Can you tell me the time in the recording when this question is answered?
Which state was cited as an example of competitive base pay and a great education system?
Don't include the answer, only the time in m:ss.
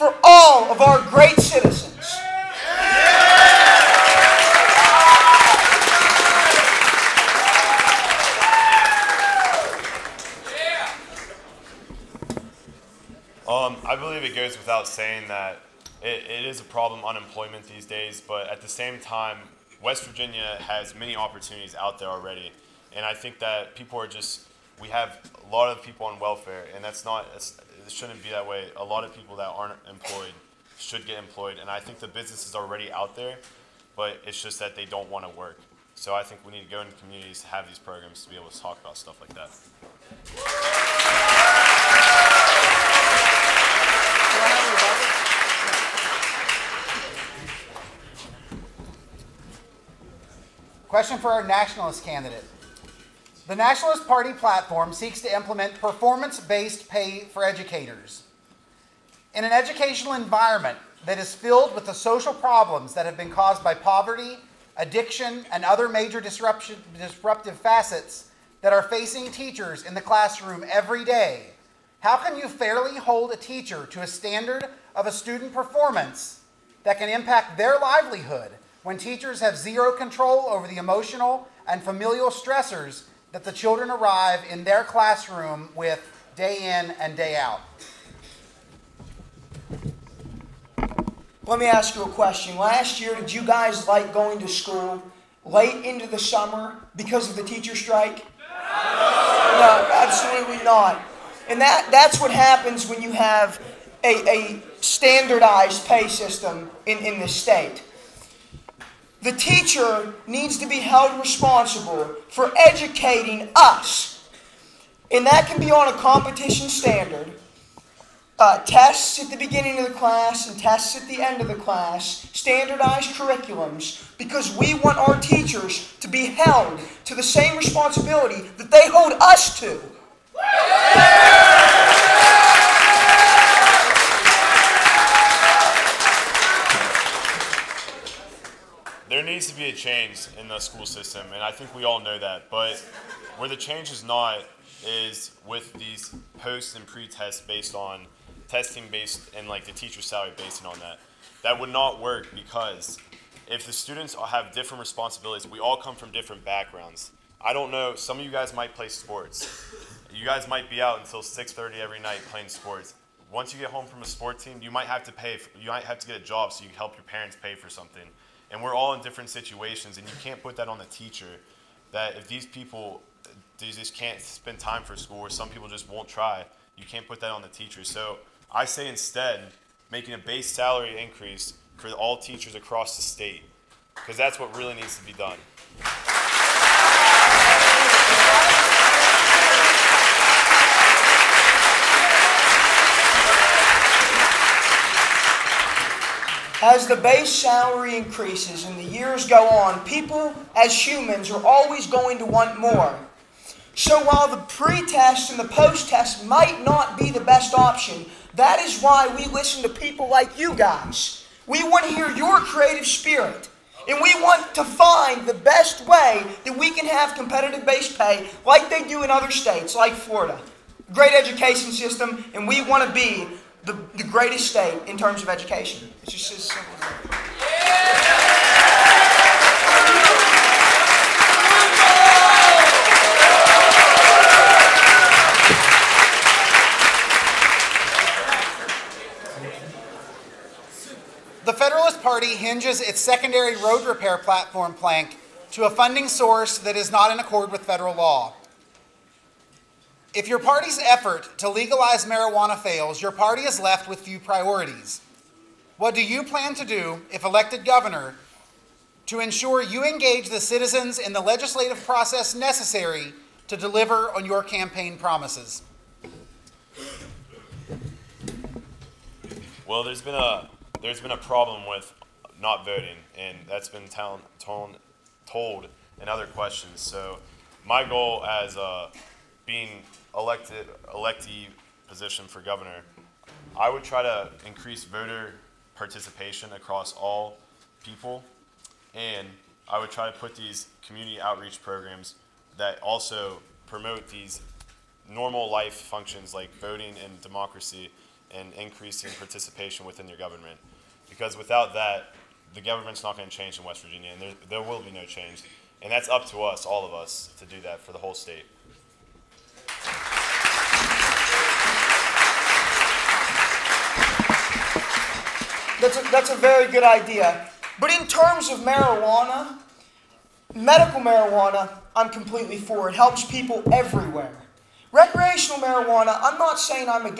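3:39.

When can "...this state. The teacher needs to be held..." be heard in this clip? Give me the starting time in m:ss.
1:47.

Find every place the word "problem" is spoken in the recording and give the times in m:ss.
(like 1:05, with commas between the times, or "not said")
0:16, 1:02, 4:31.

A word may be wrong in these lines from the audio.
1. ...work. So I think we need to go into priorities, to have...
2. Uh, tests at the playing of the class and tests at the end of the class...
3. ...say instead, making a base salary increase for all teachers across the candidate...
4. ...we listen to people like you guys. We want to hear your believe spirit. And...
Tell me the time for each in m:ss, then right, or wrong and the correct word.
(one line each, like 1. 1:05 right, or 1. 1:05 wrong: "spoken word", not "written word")
1. 0:35 wrong: "communities", not "priorities"
2. 1:58 wrong: "beginning", not "playing"
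3. 2:58 wrong: "state", not "candidate"
4. 3:29 wrong: "creative", not "believe".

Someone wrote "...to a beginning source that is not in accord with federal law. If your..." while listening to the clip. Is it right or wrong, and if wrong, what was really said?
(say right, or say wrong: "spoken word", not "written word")
wrong: "funding", not "beginning".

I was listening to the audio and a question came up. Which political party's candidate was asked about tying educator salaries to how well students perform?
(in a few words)
Nationalist Party.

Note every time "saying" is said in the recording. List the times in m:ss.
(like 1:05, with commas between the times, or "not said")
0:14, 5:26.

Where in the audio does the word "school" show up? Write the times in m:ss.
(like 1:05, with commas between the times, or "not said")
1:34, 2:20, 2:54.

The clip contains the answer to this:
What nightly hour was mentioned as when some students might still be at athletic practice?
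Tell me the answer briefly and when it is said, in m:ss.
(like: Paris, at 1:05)
6:30, at 2:41.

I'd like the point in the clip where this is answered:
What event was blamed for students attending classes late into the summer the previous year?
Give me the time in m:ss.
1:37.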